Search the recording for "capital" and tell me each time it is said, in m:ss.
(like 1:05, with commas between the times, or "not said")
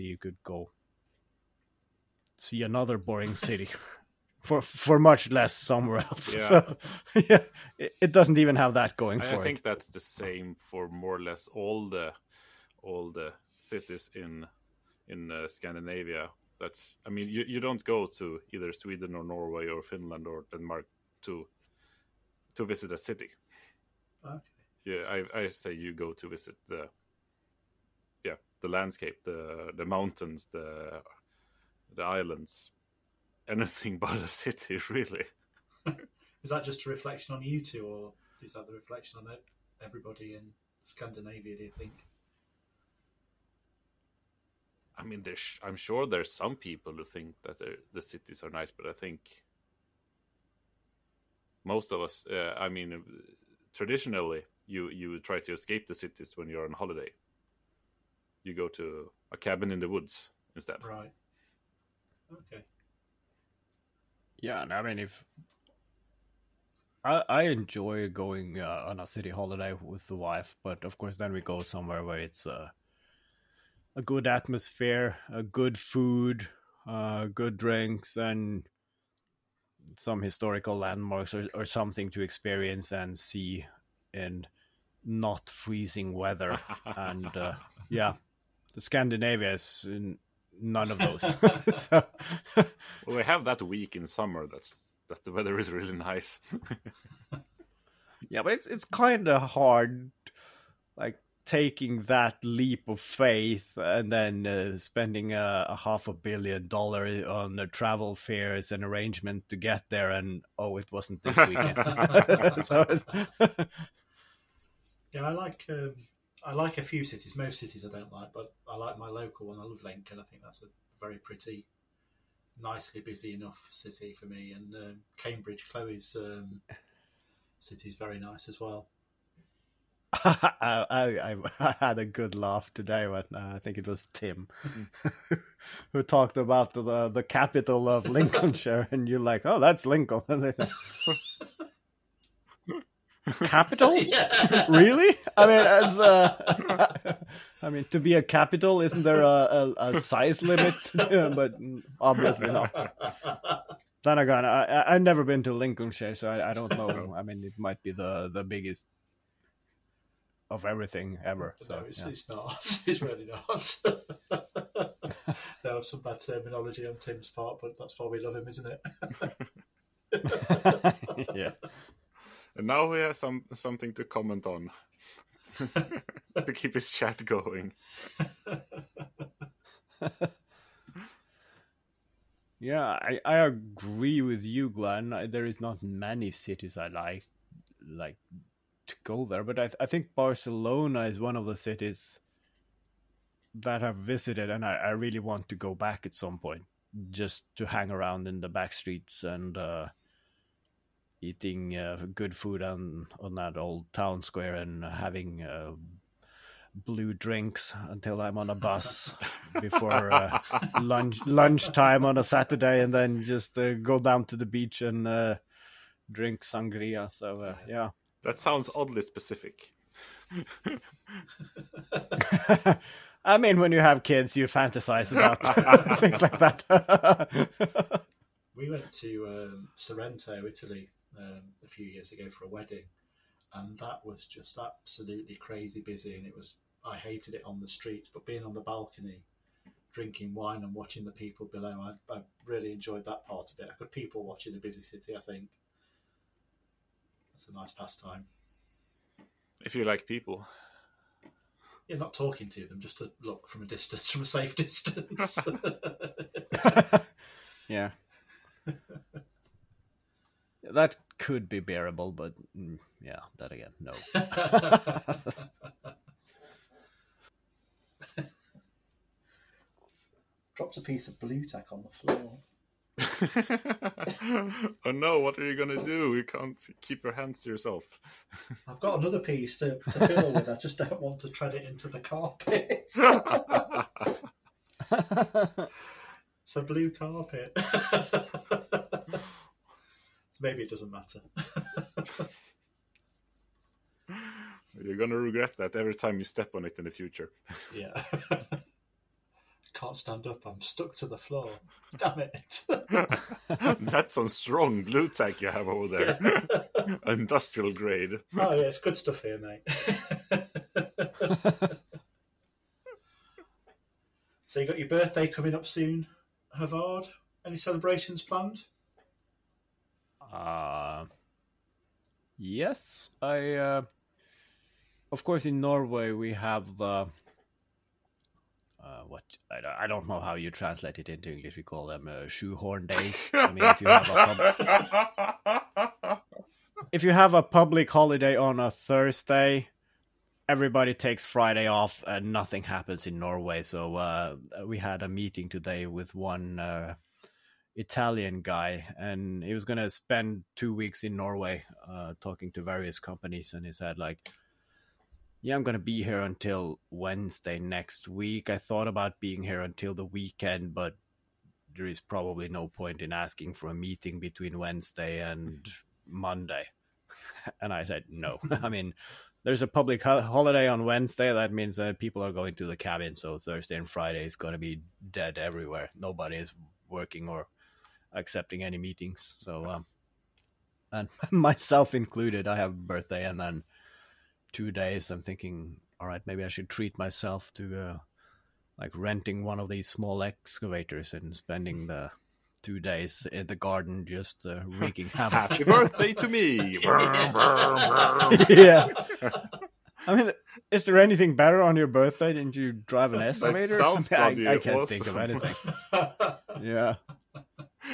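2:17, 2:23, 2:28.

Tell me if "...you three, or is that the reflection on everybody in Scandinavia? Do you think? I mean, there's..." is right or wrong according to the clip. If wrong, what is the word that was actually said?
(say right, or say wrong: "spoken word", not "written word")
wrong: "two", not "three".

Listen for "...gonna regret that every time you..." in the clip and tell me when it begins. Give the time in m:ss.
4:54.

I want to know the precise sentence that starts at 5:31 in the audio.
We call them uh, shoehorn days.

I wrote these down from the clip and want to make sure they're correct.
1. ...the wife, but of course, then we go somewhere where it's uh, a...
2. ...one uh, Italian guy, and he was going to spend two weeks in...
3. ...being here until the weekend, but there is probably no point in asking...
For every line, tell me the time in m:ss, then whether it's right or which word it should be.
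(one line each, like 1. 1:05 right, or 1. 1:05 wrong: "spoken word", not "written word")
1. 1:10 right
2. 5:46 right
3. 5:59 right.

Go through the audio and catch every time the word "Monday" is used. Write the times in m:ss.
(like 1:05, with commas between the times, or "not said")
6:06.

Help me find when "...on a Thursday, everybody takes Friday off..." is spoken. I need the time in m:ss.
5:38.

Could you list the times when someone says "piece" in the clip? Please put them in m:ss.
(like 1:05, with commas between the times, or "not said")
4:30, 4:39.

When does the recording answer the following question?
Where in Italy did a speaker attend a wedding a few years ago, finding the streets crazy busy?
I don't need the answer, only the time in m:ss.
3:49.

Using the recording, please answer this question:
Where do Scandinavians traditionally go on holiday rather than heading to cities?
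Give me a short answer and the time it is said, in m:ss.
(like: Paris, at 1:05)
A cabin in the woods, at 0:59.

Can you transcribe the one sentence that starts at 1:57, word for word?
Most cities I don't like, but I like my local one.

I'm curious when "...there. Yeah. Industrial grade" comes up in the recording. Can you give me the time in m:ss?
5:05.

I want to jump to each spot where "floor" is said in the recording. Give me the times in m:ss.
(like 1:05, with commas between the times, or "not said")
4:31, 5:01.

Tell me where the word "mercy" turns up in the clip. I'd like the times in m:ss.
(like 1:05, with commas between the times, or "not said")
not said.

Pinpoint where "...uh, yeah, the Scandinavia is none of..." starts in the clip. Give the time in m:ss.
1:27.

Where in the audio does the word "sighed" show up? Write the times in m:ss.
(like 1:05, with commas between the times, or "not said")
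not said.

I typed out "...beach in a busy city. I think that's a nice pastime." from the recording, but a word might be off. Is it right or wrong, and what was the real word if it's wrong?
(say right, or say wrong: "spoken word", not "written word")
wrong: "watch", not "beach".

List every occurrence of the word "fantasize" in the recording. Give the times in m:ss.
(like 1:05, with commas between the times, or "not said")
3:44.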